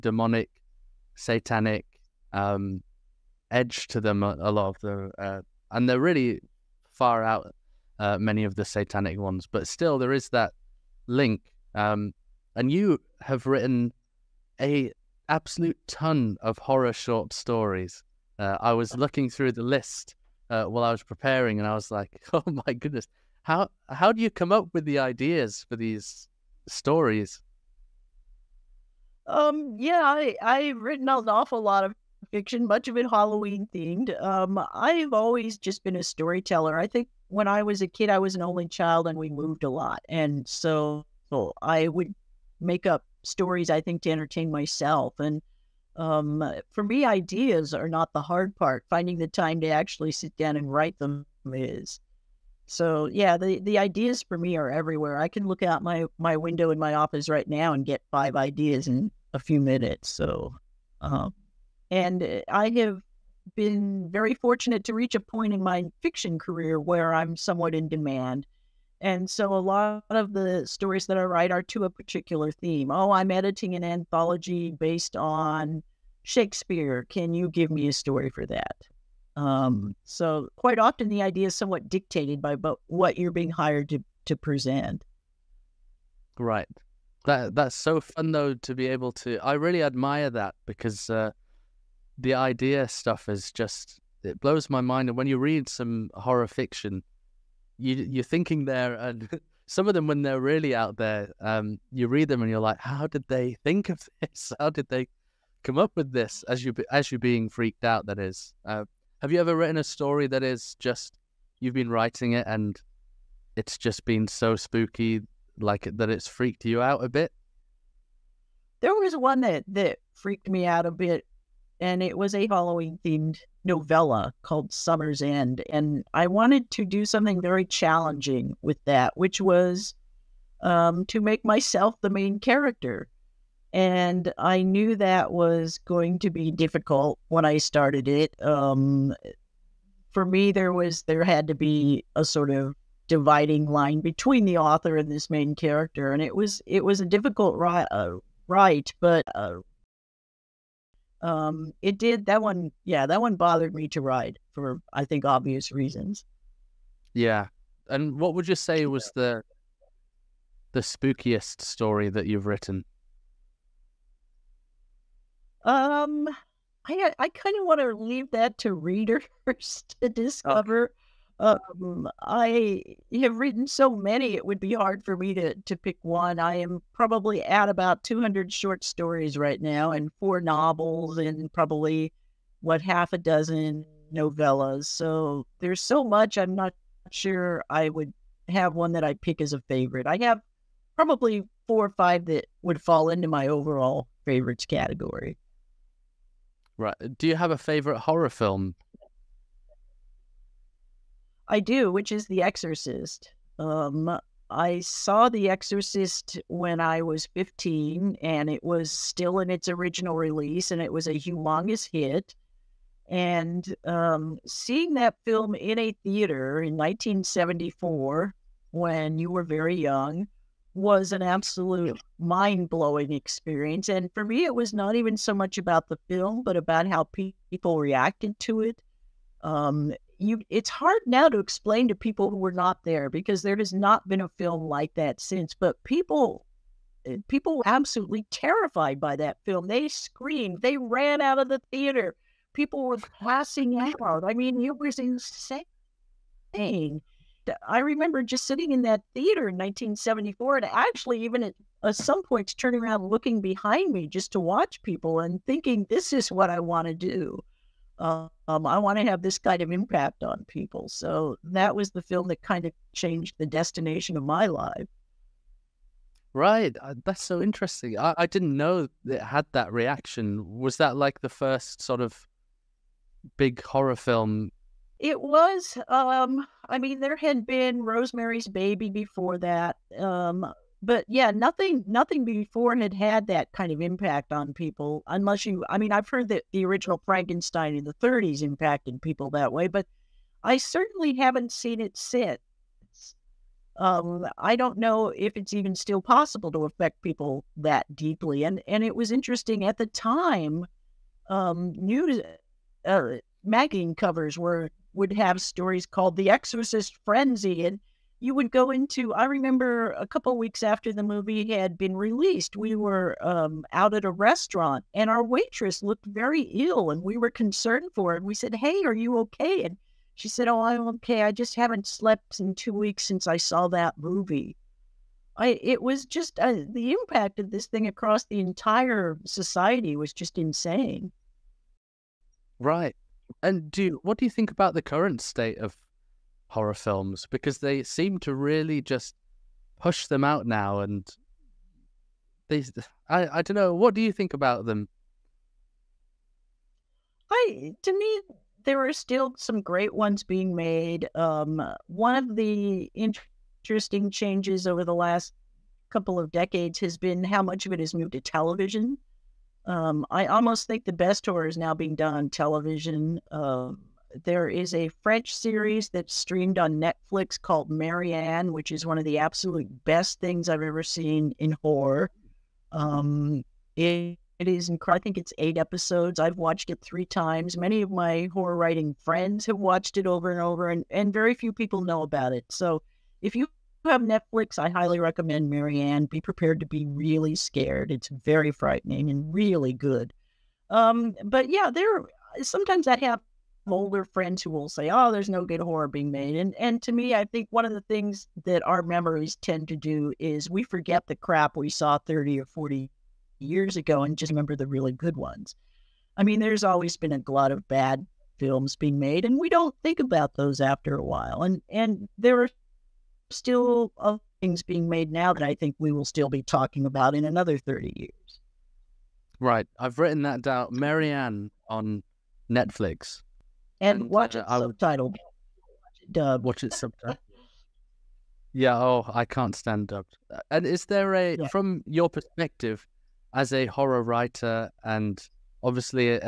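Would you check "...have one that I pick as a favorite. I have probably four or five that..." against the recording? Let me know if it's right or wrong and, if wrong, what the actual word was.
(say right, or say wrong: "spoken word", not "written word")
right.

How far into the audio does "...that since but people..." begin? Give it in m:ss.
3:54.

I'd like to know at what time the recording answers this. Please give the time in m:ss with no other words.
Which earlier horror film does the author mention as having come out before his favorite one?
4:37.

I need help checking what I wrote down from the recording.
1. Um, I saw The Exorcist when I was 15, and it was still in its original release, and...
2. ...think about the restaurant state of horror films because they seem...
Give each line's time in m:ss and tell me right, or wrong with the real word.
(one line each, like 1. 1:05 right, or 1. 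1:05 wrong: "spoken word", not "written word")
1. 3:23 right
2. 5:34 wrong: "current", not "restaurant".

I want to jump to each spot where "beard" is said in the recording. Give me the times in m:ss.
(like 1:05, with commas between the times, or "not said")
not said.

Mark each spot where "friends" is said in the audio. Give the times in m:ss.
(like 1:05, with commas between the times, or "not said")
6:19, 6:34.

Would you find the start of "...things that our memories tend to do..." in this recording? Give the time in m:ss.
6:37.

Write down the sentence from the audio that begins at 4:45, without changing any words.
I mean, I've heard that the original Frankenstein in the '30s impacted people that way, but I certainly haven't seen it since.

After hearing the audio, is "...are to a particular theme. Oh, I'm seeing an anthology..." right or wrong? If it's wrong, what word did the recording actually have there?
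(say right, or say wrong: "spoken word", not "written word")
wrong: "editing", not "seeing".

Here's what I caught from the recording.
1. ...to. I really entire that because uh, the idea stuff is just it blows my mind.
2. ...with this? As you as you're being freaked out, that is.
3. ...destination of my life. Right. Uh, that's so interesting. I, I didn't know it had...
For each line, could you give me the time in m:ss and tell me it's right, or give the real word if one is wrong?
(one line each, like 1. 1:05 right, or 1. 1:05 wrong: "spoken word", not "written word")
1. 1:29 wrong: "admire", not "entire"
2. 1:45 right
3. 4:23 right.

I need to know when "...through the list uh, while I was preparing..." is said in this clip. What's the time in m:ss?
0:19.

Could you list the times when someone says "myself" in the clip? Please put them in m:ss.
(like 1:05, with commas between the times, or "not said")
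0:44, 2:11.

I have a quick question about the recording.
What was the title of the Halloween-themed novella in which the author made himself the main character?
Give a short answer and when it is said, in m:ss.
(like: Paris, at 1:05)
Summer's End, at 2:04.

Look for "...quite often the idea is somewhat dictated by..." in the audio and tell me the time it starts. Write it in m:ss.
1:20.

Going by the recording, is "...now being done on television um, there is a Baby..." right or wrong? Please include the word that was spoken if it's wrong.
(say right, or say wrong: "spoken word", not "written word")
wrong: "French", not "Baby".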